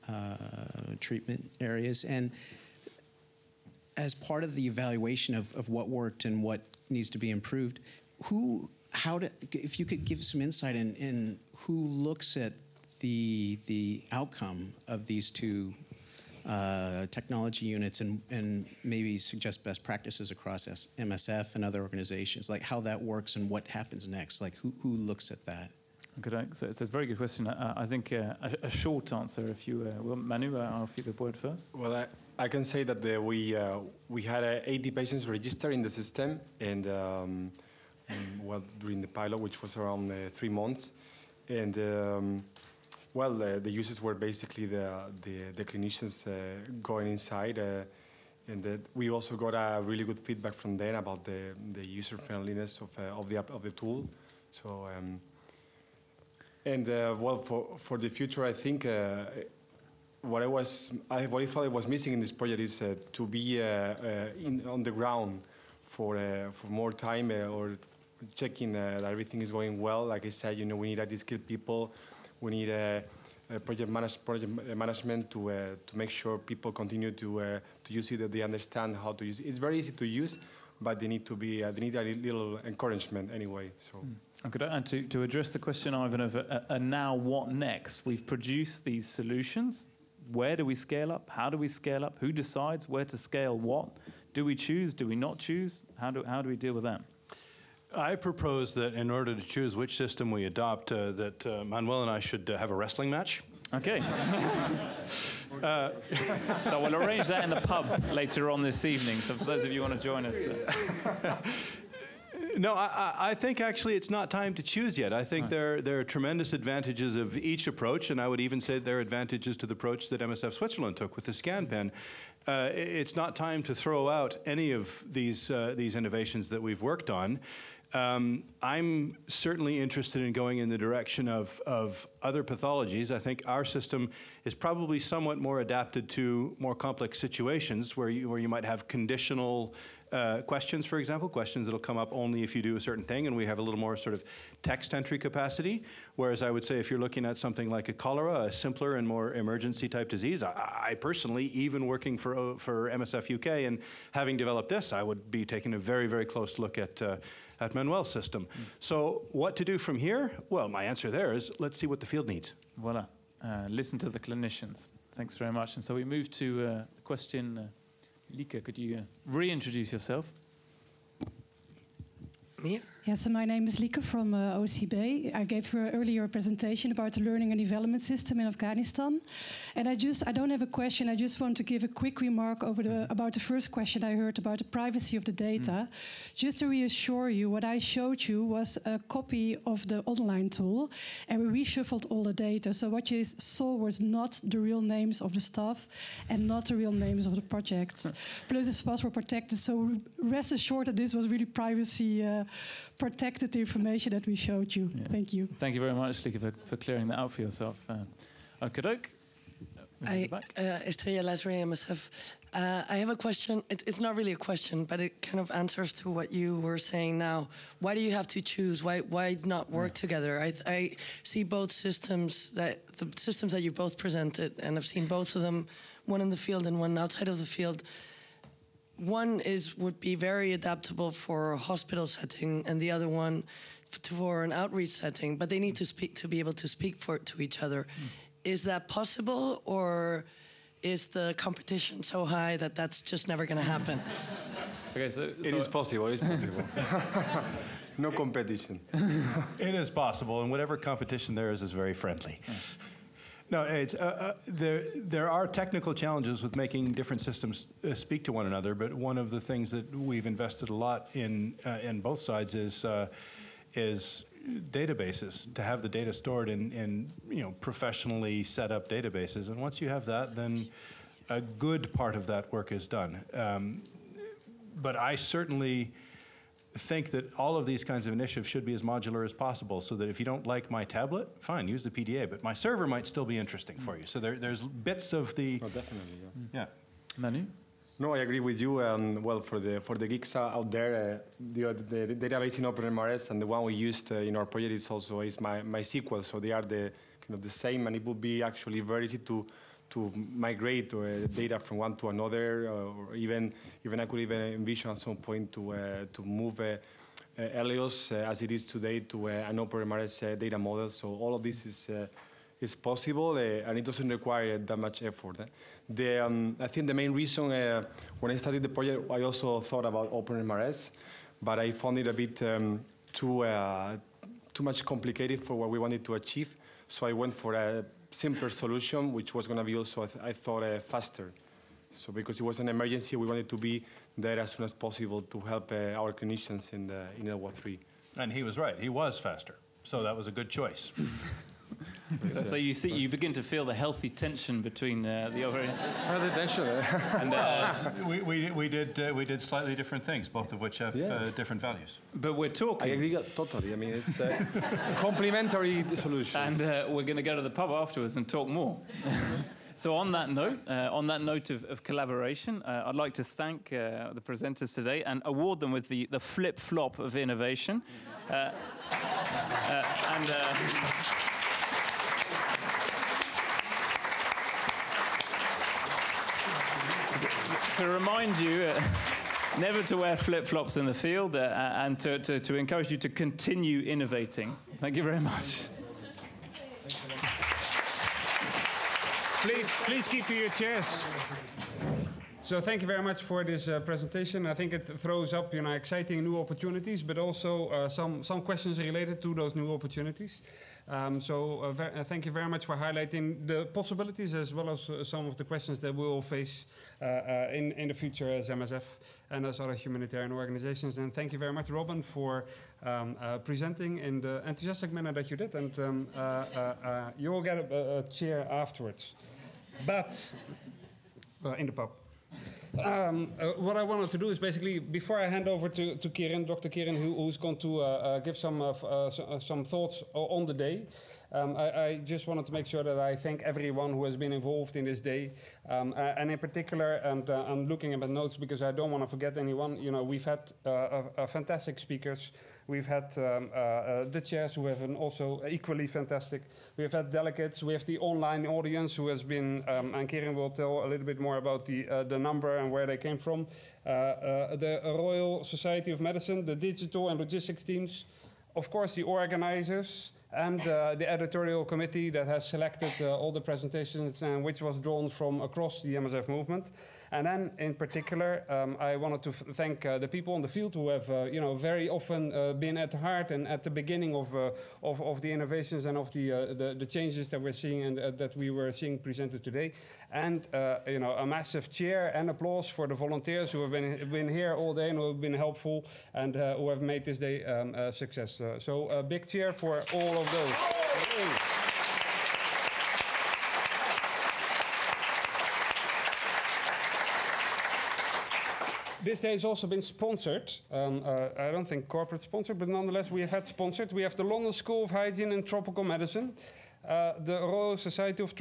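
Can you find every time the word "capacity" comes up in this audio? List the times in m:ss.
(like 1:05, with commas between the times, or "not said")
2:25.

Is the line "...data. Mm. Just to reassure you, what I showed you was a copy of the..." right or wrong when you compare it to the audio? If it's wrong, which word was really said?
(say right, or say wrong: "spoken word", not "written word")
right.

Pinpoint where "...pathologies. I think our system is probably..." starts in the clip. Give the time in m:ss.
2:12.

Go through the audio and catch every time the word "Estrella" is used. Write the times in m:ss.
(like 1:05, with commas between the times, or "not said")
3:30.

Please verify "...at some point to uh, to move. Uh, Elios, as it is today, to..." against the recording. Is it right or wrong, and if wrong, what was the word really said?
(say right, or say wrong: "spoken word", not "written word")
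right.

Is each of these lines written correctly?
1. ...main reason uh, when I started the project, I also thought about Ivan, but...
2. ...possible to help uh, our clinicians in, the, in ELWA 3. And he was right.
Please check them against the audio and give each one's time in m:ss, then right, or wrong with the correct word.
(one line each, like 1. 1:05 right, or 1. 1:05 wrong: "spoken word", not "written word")
1. 5:16 wrong: "OpenMRS", not "Ivan"
2. 5:34 right.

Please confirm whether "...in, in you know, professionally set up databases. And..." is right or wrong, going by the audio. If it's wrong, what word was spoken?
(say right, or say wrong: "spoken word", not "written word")
right.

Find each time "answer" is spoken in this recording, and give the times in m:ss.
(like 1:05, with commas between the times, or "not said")
0:29, 2:40, 3:35.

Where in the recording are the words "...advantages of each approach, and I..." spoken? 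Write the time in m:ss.
1:56.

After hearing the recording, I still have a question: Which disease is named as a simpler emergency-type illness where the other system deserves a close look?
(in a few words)
cholera.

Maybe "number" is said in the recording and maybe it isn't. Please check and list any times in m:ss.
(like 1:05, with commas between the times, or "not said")
7:32.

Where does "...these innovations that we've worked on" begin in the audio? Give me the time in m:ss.
2:05.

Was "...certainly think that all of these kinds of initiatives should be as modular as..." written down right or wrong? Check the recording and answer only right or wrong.
right.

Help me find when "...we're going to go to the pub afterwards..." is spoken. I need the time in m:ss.
5:56.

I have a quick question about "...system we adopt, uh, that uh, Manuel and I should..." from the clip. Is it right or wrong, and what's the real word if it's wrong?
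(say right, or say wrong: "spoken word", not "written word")
right.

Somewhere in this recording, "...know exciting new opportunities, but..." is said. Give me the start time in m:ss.
6:35.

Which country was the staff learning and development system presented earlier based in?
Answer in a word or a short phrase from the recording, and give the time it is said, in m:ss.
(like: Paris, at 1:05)
Afghanistan, at 2:58.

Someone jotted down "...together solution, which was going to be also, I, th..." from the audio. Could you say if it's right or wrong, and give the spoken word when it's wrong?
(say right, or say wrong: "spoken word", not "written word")
wrong: "simpler", not "together".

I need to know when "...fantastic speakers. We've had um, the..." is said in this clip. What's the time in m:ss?
7:21.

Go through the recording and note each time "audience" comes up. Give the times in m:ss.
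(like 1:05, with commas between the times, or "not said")
7:28.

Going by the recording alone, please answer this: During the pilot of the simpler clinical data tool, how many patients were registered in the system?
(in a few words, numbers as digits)
80.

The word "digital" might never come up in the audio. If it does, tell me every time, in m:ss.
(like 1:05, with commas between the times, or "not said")
7:36.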